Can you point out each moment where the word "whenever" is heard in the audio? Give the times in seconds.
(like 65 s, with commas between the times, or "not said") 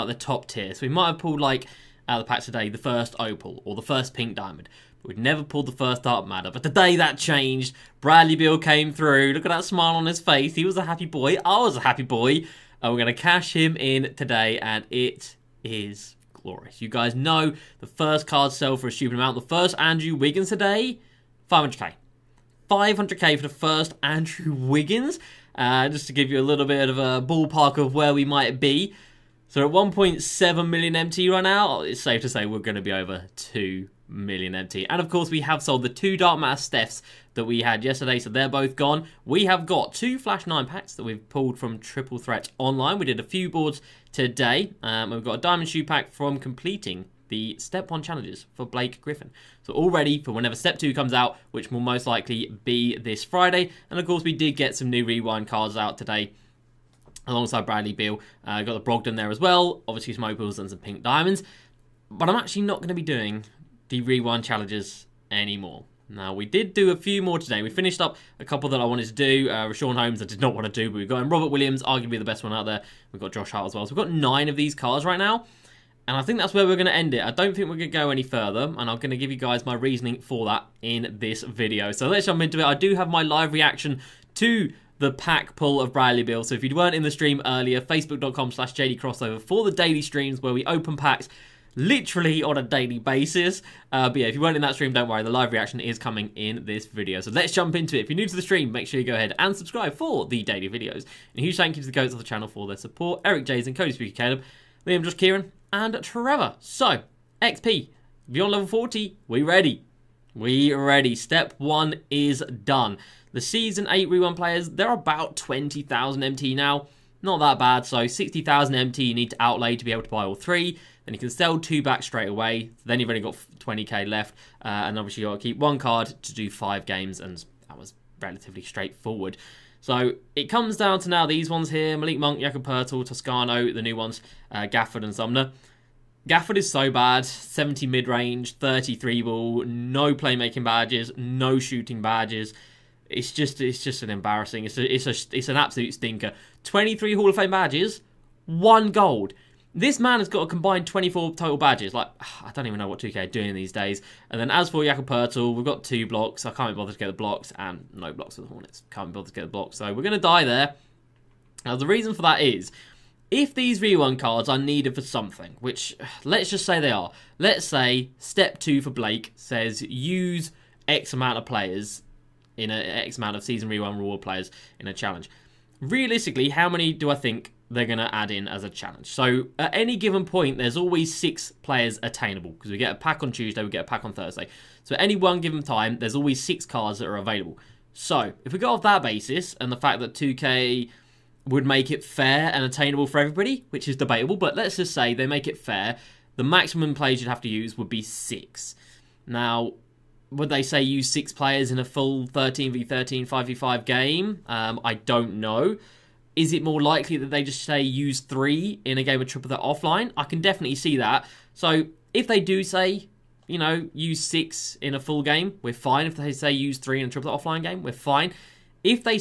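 50 s.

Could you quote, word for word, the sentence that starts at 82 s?
I do have my live reaction to the pack pull of Bradley Beal.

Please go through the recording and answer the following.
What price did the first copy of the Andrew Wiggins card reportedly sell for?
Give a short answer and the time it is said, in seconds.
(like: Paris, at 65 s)
500k, at 19 s.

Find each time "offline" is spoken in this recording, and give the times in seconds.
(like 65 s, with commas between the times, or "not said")
209 s, 217 s.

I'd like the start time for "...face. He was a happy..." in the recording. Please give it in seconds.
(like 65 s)
10 s.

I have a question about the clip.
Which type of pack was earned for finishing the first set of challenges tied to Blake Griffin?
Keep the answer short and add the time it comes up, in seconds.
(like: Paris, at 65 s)
Diamond Shoe pack, at 45 s.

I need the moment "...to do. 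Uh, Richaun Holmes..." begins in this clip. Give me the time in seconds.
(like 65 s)
69 s.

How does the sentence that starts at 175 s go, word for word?
Realistically, how many do I think they're going to add in as a challenge.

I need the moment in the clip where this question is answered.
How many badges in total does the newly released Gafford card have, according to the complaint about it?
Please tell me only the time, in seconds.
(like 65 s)
150 s.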